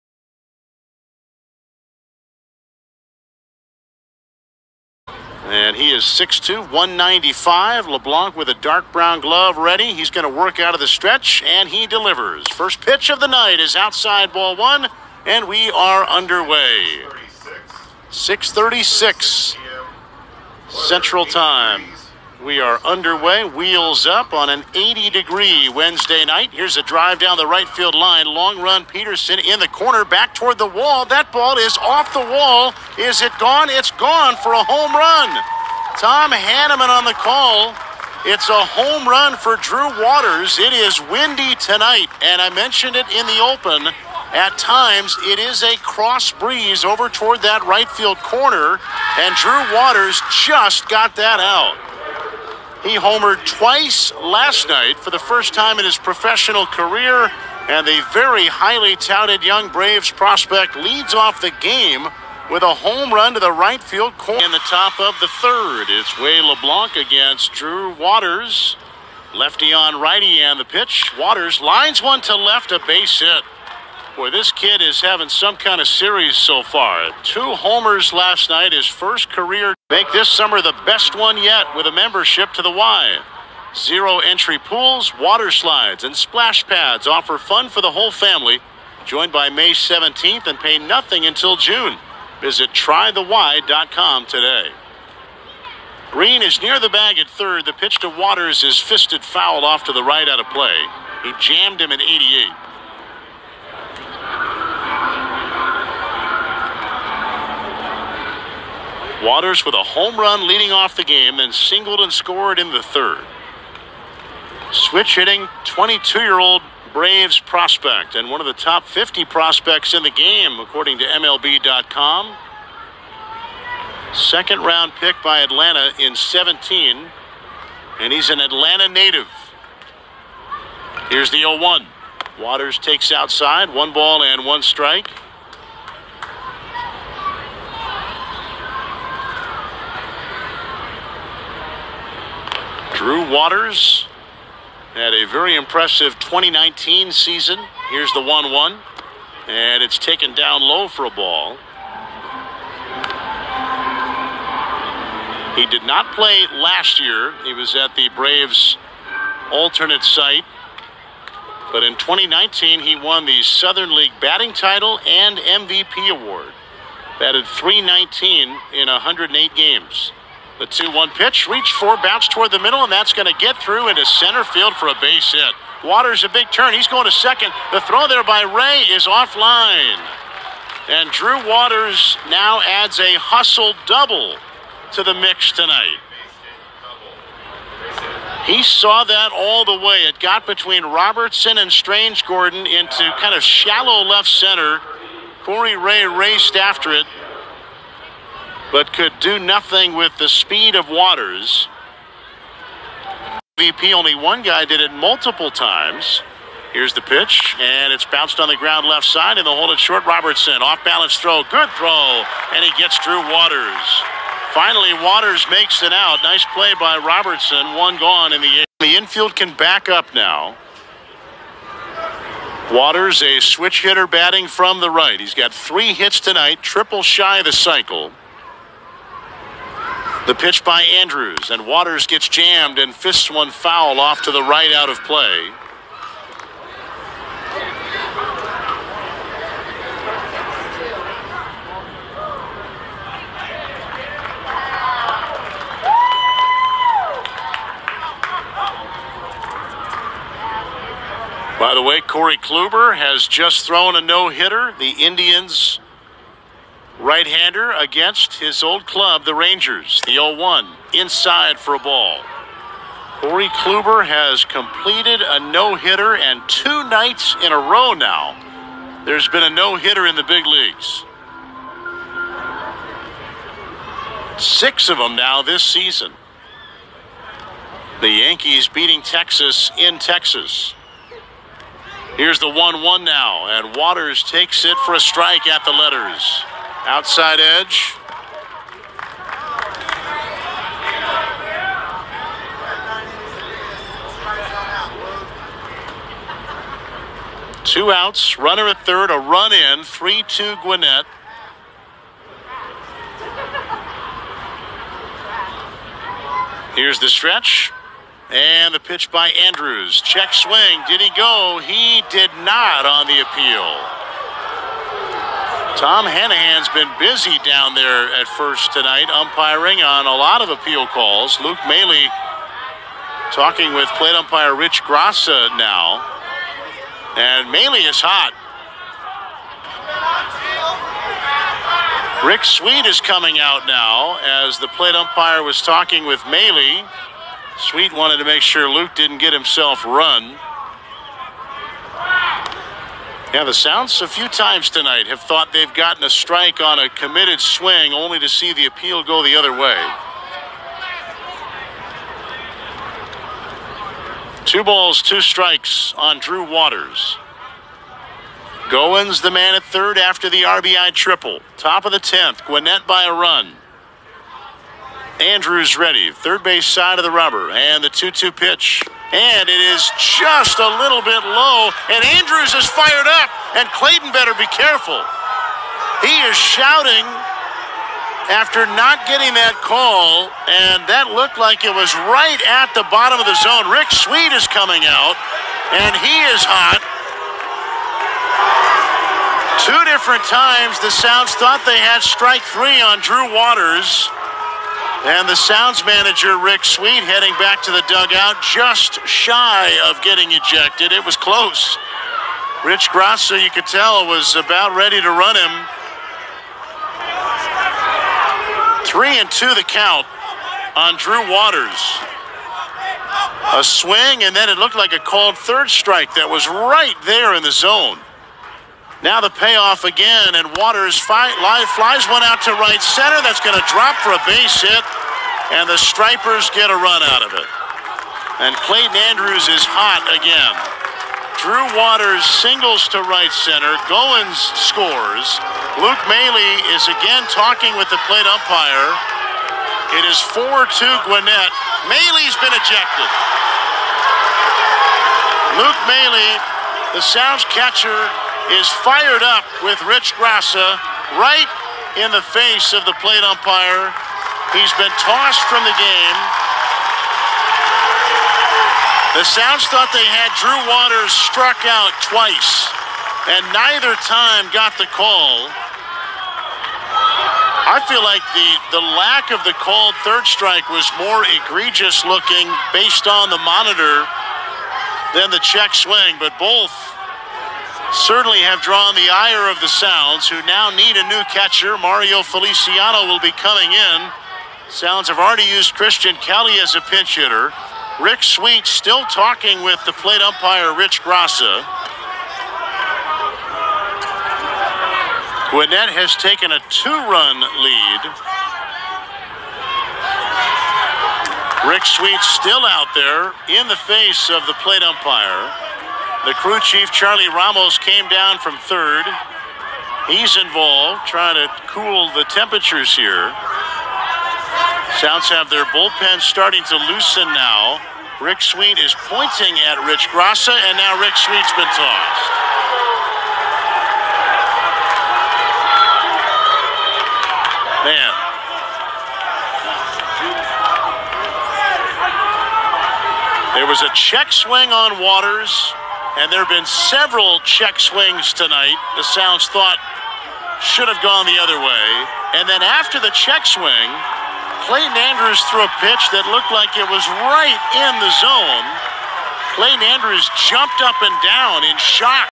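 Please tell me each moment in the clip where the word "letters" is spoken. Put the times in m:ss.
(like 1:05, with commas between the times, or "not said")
4:45.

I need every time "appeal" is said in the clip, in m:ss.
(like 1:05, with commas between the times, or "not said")
5:13, 5:20, 5:48.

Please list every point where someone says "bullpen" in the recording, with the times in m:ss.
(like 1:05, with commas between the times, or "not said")
8:35.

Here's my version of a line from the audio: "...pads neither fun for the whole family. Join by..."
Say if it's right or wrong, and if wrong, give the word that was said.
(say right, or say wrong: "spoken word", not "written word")
wrong: "offer", not "neither".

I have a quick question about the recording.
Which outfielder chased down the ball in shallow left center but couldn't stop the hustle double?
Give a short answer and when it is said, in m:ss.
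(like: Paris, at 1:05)
Corey Ray, at 3:15.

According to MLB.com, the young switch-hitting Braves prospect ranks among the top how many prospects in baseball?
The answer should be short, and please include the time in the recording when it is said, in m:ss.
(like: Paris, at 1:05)
50, at 1:58.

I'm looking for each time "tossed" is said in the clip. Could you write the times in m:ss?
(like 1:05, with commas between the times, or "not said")
7:34, 8:41.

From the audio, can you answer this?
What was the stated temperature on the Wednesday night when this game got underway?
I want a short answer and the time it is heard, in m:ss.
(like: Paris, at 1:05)
80 degrees, at 0:24.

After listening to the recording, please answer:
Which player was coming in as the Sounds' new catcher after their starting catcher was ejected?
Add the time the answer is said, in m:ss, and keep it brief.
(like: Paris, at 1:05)
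Mario Feliciano, at 8:01.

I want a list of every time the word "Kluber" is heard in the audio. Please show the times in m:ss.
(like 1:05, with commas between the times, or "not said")
4:12, 4:23.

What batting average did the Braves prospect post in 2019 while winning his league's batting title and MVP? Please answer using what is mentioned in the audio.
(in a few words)
319.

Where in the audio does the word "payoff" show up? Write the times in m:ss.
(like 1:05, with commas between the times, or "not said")
6:59.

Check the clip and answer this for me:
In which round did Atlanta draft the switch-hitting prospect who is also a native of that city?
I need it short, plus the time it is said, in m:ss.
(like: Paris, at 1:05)
Second round, at 2:04.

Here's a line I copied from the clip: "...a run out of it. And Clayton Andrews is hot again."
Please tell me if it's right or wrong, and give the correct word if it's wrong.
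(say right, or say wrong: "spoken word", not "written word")
right.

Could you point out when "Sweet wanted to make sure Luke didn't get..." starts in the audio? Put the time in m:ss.
5:37.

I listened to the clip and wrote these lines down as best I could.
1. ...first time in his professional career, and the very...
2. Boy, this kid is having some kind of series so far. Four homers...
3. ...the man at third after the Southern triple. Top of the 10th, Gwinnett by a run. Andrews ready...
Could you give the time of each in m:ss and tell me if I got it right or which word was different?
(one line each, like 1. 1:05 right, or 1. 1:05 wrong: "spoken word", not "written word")
1. 0:55 right
2. 1:14 wrong: "Two", not "Four"
3. 5:59 wrong: "RBI", not "Southern".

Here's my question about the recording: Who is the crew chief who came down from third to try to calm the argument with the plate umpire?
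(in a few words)
Charlie Ramos.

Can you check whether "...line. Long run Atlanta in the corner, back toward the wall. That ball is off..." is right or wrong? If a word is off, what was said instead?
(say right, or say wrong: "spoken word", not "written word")
wrong: "Peterson", not "Atlanta".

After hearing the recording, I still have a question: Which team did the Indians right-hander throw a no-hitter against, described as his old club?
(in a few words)
Rangers.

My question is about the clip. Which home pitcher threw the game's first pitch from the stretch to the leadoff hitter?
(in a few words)
Wade LeBlanc.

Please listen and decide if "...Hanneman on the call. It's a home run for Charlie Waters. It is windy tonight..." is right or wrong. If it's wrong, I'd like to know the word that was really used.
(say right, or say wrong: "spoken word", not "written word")
wrong: "Drew", not "Charlie".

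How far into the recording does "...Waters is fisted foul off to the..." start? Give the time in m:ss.
1:38.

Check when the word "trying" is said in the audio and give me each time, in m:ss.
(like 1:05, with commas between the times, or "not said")
8:31.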